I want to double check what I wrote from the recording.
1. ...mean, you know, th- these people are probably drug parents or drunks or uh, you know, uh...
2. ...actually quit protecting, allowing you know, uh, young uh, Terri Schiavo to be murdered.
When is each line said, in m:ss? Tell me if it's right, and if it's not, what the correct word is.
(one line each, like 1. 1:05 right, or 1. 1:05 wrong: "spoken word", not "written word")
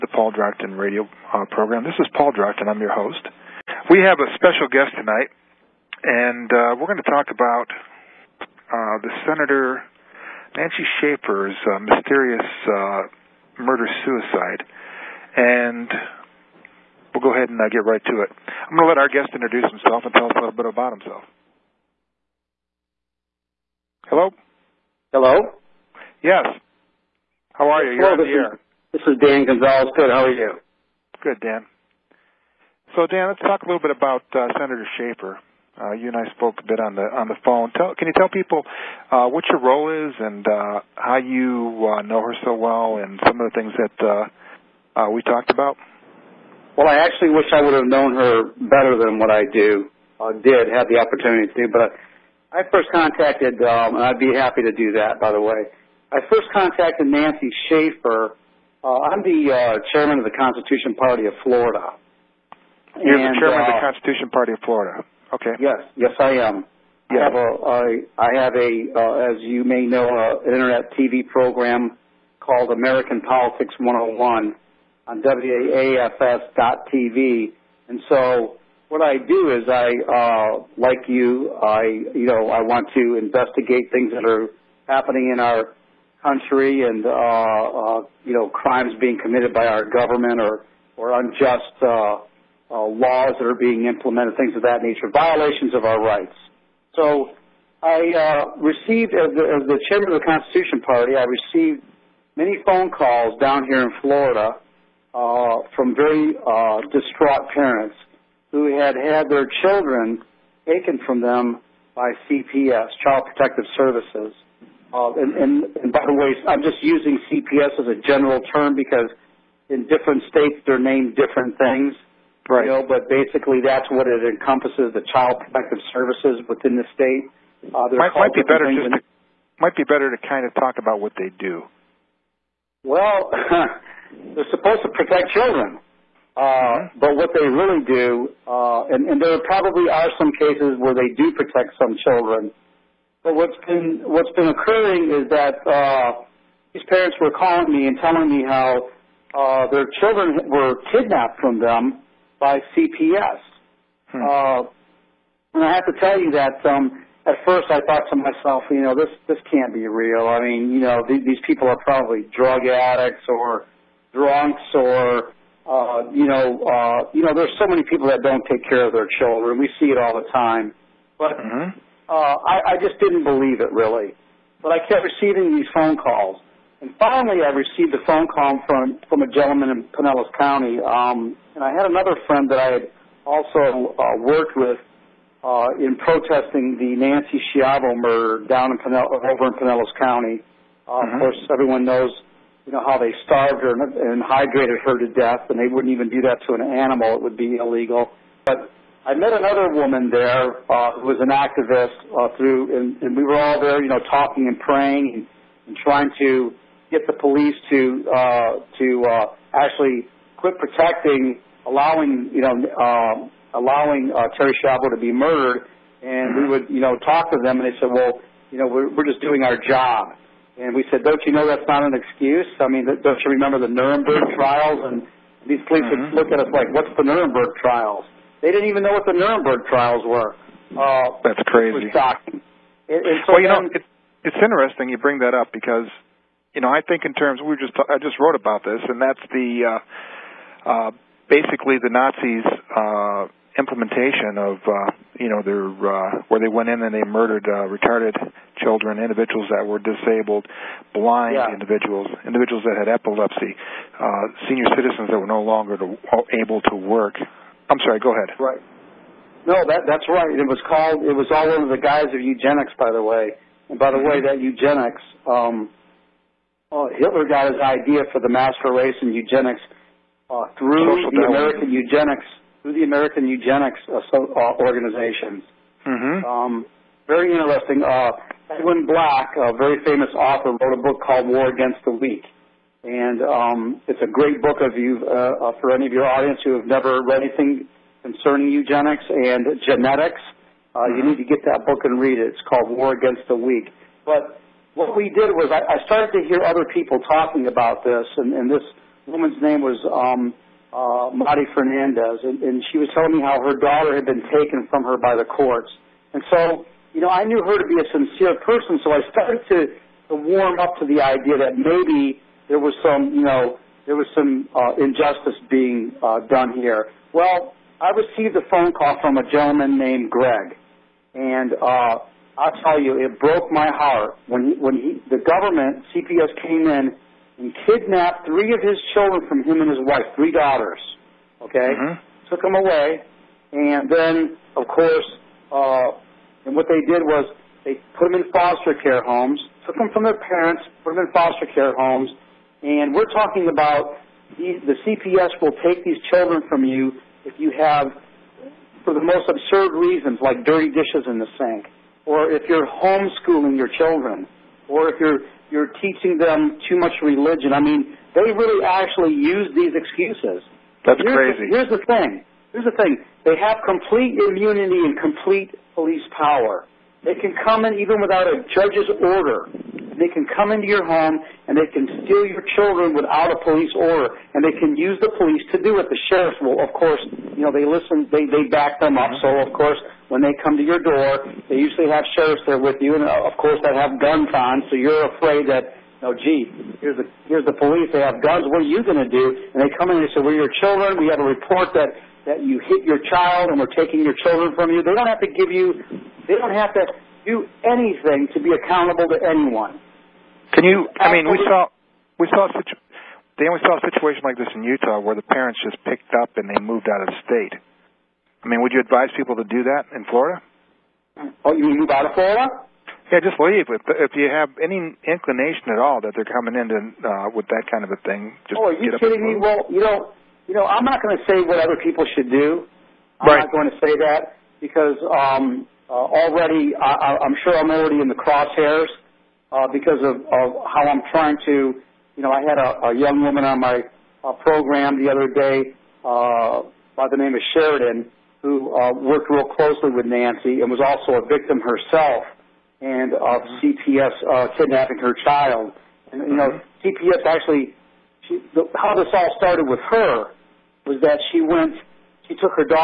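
1. 2:40 wrong: "addicts", not "parents"
2. 3:29 wrong: "allowing", not "young".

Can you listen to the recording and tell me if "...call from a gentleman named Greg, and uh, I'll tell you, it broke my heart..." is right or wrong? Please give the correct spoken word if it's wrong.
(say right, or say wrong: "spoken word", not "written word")
right.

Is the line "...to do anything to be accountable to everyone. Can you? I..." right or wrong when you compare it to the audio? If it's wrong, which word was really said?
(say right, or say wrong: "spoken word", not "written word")
wrong: "anyone", not "everyone".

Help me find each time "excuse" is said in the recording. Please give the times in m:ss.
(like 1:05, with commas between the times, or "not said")
3:41, 5:59.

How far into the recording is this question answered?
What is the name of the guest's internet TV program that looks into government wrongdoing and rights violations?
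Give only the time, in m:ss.
1:12.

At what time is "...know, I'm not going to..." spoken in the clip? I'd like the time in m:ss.
7:00.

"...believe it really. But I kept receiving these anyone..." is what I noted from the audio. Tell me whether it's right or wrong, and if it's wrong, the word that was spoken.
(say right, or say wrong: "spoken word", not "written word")
wrong: "phone", not "anyone".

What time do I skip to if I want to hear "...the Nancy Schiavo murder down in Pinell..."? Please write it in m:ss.
3:06.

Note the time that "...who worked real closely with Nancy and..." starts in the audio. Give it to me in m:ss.
7:18.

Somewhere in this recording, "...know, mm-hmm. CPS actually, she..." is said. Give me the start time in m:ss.
7:26.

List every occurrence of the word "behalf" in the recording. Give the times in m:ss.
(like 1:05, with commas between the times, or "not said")
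not said.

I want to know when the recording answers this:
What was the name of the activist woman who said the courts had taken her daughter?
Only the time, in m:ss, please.
5:01.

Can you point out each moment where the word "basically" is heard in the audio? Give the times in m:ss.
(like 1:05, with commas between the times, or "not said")
2:03, 4:01.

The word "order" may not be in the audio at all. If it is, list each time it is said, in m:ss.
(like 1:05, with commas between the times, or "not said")
6:08, 6:13.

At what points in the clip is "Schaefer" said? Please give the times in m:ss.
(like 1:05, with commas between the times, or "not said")
0:10, 0:34, 0:57.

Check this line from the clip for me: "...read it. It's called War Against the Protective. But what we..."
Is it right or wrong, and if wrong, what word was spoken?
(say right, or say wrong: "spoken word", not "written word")
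wrong: "Weak", not "Protective".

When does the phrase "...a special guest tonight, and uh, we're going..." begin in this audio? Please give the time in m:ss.
0:04.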